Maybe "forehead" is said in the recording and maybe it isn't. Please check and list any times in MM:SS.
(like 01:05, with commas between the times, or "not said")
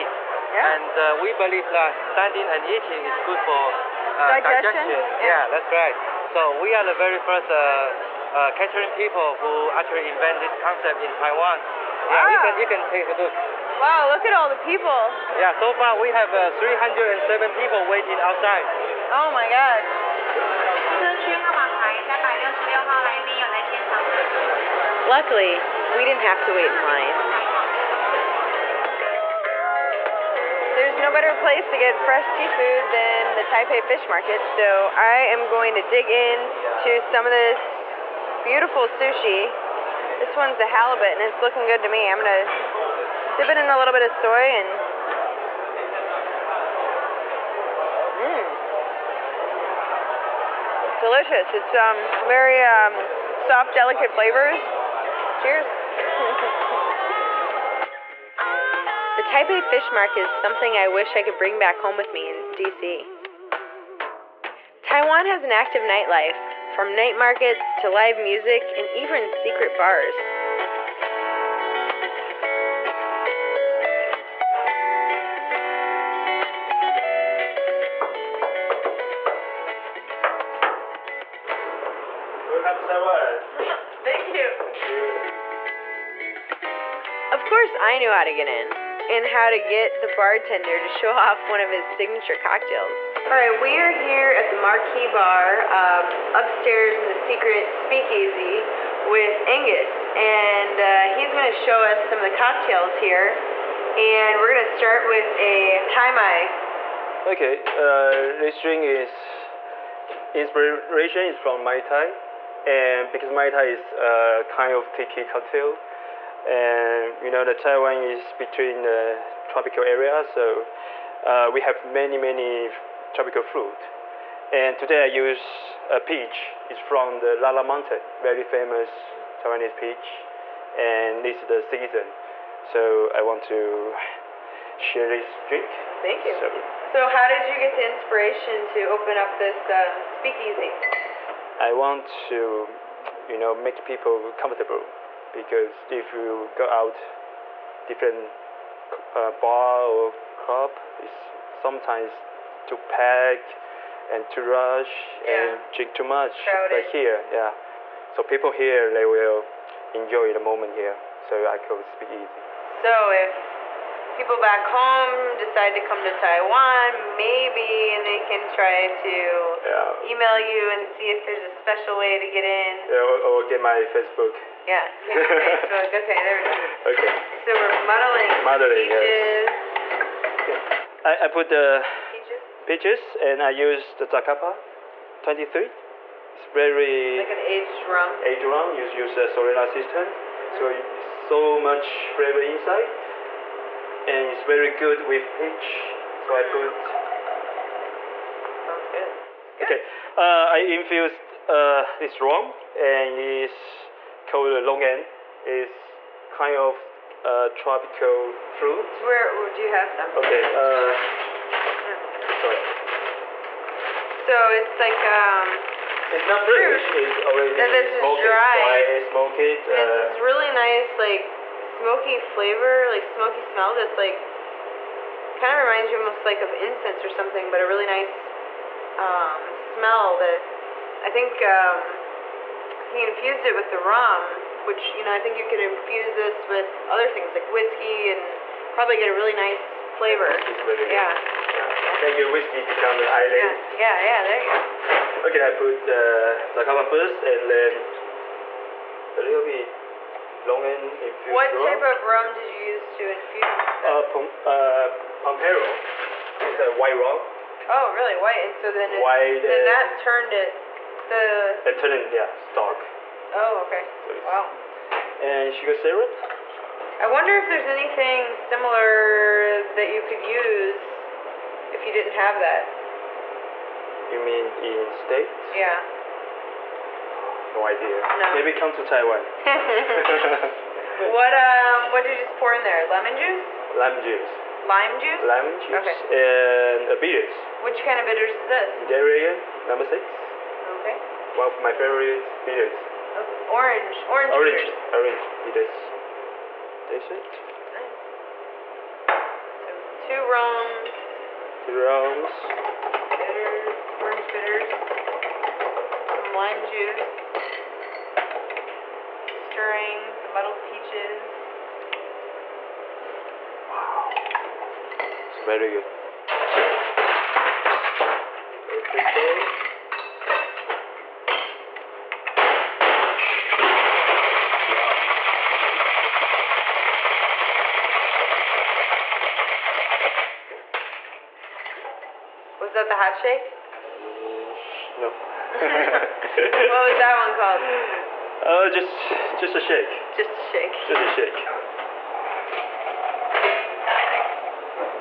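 not said.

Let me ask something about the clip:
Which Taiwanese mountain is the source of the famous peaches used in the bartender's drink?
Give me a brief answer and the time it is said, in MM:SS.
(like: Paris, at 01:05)
Lala Mountain, at 02:07.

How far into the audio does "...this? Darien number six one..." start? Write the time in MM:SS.
04:48.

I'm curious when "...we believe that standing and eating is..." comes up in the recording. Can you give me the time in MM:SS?
00:01.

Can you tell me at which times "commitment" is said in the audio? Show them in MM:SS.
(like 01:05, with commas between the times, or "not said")
not said.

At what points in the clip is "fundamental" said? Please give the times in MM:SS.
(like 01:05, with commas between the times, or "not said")
not said.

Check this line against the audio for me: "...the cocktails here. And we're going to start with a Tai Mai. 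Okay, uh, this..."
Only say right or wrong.
right.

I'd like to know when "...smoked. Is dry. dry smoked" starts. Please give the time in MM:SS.
03:37.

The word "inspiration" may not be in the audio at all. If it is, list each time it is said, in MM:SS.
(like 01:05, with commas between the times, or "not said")
01:50, 02:17.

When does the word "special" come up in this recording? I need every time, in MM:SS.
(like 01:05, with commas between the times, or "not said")
02:51.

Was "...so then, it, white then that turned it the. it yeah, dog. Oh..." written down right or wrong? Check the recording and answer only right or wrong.
right.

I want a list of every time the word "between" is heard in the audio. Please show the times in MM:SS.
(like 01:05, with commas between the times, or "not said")
01:58.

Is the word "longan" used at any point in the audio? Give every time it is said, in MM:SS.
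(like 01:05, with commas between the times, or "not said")
03:24, 04:10.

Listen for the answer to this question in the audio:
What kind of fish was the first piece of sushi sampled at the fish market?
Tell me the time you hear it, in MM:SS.
00:40.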